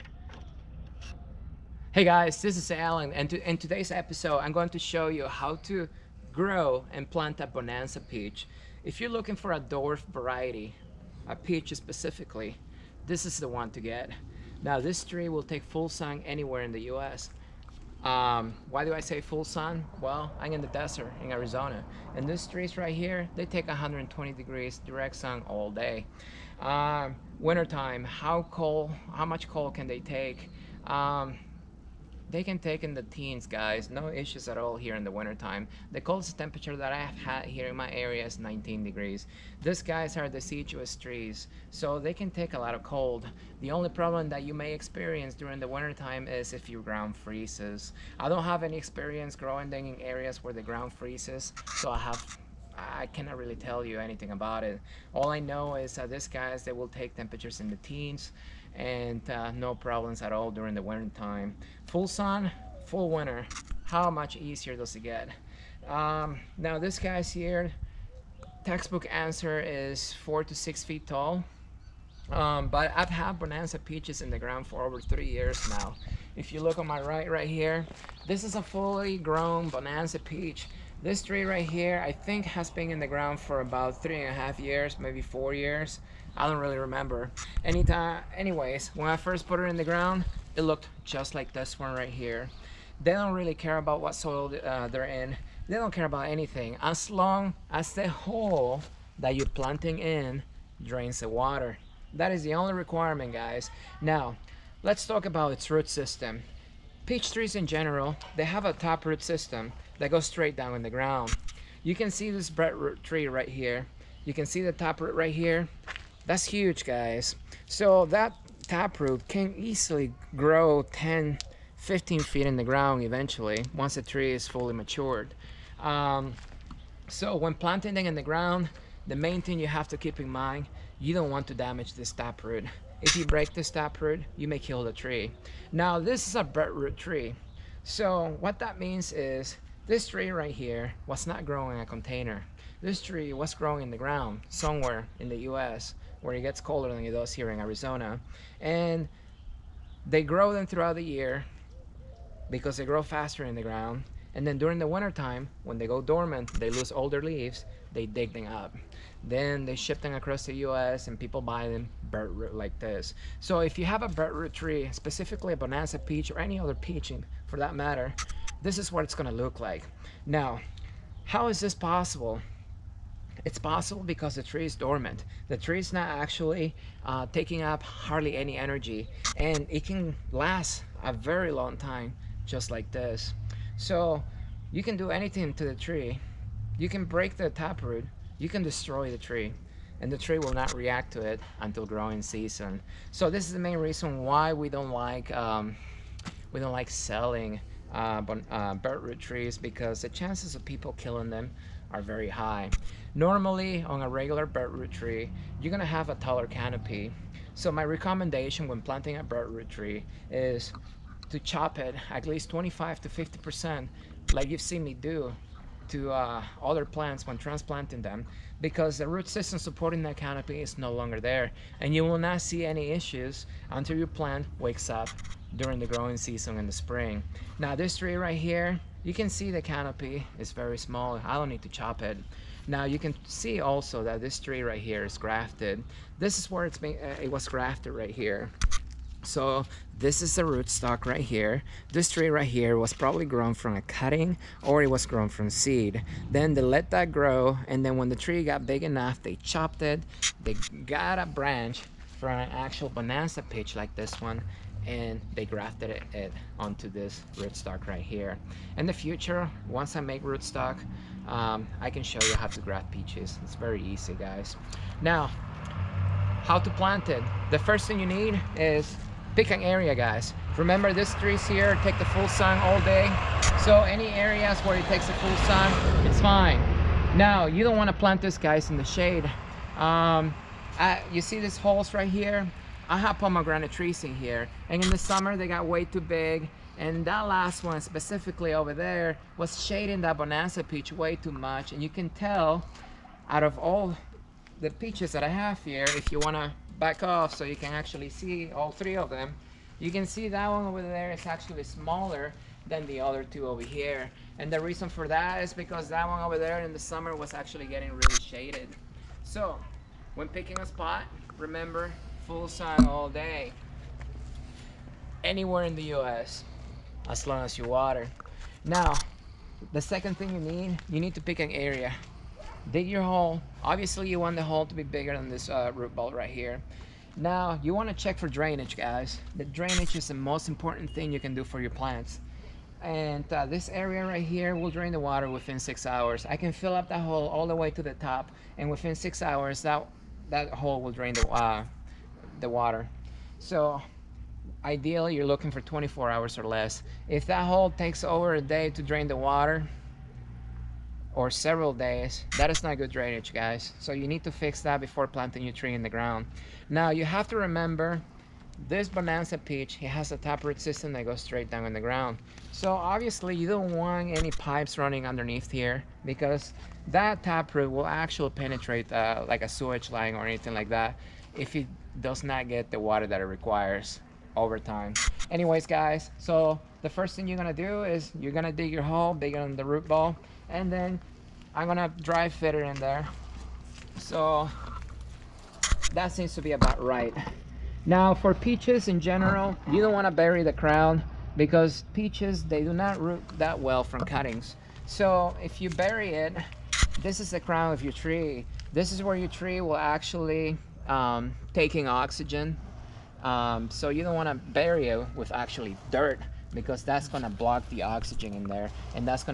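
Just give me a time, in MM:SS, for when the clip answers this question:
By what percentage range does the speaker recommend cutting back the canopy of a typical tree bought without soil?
03:32.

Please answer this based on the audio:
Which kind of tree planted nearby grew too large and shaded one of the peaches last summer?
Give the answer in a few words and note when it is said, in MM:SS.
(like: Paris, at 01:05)
Pomegranate, at 04:43.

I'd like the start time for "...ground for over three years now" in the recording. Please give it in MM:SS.
01:14.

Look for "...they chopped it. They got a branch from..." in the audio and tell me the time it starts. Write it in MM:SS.
04:09.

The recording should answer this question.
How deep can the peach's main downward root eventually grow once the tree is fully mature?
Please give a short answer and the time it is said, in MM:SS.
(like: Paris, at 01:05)
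10 to 15 feet, at 02:00.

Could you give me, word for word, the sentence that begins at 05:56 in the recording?
Now you have to remember this Bonanza peach, it has a taproot system that goes straight down in the ground.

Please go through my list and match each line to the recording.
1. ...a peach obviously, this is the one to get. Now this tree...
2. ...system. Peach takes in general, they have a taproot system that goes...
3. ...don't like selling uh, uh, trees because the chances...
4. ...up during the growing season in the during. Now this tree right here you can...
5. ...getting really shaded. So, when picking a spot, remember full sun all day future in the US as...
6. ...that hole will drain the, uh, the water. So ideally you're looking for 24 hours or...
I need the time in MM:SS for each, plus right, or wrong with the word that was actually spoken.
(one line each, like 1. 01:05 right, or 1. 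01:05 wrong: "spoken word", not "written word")
1. 00:11 wrong: "specifically", not "obviously"
2. 01:45 wrong: "trees", not "takes"
3. 03:16 right
4. 03:44 wrong: "spring", not "during"
5. 05:07 wrong: "anywhere", not "future"
6. 05:40 right.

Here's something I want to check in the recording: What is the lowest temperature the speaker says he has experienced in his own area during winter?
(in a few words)
19 degrees.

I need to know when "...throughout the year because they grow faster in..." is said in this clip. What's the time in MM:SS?
02:30.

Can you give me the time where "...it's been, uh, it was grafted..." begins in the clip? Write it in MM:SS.
03:56.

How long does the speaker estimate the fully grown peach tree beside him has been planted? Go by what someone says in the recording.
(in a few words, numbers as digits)
3 and a half years.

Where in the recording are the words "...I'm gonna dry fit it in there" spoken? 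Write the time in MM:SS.
06:21.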